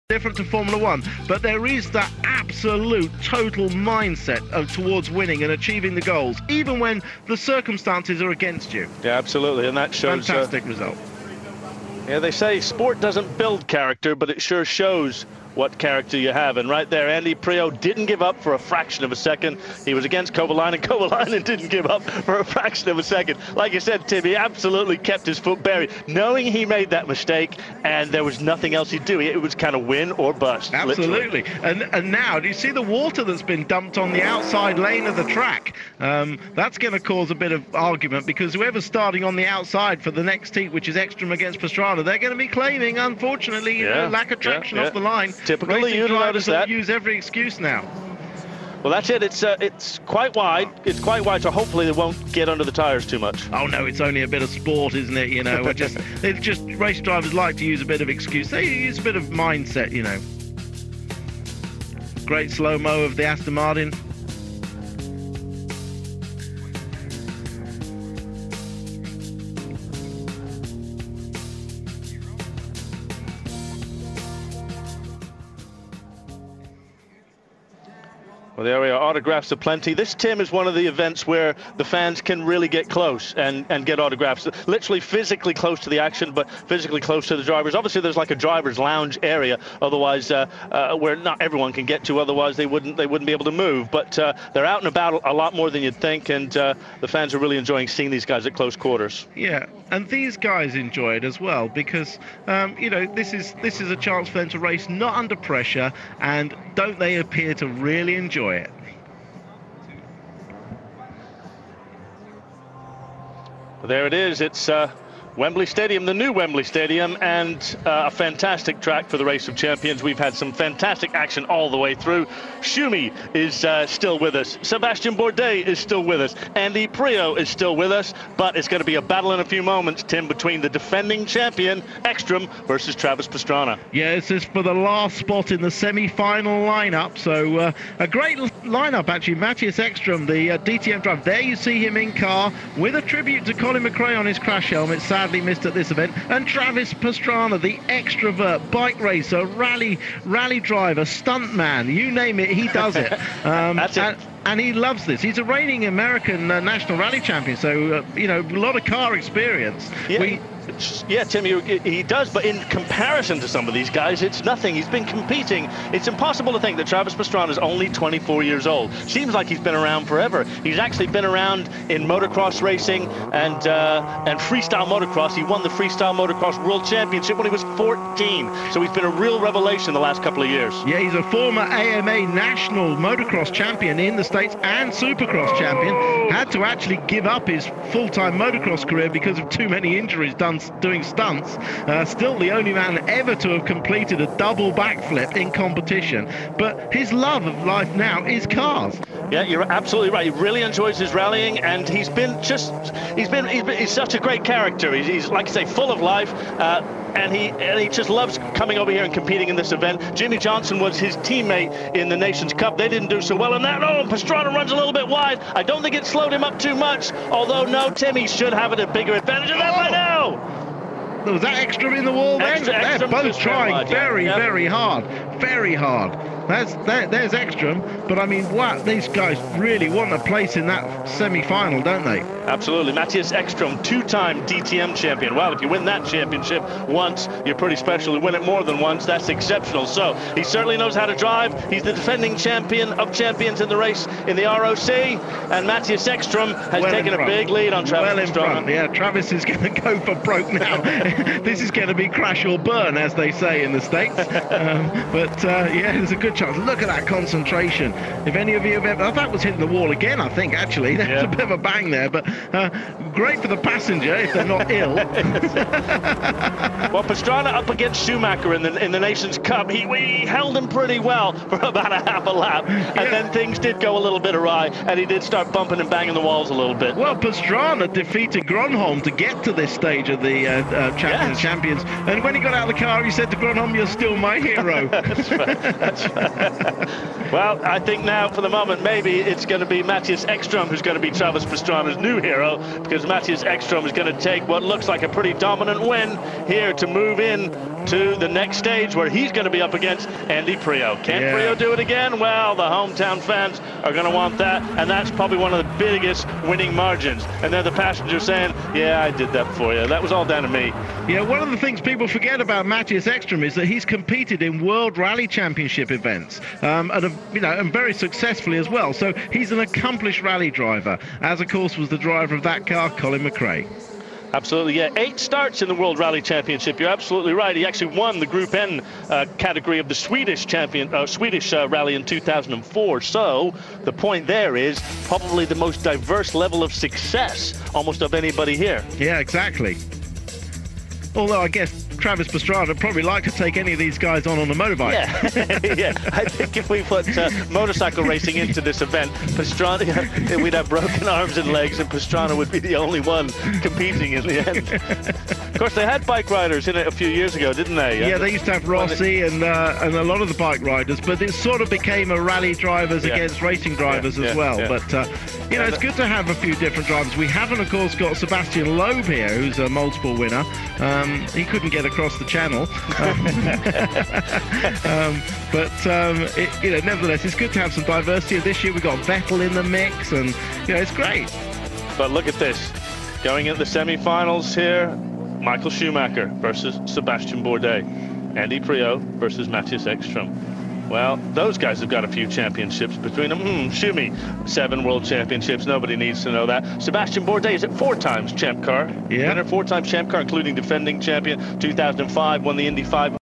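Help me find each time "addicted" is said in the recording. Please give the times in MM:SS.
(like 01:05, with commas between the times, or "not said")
not said.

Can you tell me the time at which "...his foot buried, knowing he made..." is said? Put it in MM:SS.
00:25.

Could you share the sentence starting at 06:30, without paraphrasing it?
Well, those guys have got a few championships between them.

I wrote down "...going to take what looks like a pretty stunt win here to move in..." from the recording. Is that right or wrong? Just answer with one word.
wrong.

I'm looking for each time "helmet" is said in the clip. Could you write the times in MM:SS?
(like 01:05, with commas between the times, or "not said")
02:24.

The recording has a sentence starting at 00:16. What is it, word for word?
And right there, Andy Priaulx didn't give up for a fraction of a second.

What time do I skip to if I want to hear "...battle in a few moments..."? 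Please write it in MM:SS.
02:09.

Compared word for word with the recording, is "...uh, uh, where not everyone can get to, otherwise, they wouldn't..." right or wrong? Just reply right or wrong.
right.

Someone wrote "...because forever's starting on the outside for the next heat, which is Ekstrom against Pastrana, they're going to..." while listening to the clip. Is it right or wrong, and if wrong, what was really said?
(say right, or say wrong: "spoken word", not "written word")
wrong: "whoever", not "forever".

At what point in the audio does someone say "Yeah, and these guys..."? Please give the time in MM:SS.
01:39.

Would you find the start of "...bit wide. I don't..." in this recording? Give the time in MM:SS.
03:34.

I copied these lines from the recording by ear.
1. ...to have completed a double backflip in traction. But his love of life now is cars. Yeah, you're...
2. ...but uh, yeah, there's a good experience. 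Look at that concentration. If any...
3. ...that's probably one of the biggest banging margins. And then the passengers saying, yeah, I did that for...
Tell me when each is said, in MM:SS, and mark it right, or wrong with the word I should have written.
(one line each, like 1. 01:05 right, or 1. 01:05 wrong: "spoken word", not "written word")
1. 03:13 wrong: "competition", not "traction"
2. 04:15 wrong: "chance", not "experience"
3. 05:04 wrong: "winning", not "banging".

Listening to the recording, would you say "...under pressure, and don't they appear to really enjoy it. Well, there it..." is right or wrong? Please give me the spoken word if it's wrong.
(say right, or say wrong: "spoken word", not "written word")
right.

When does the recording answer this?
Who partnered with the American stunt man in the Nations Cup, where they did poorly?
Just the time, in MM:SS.
03:30.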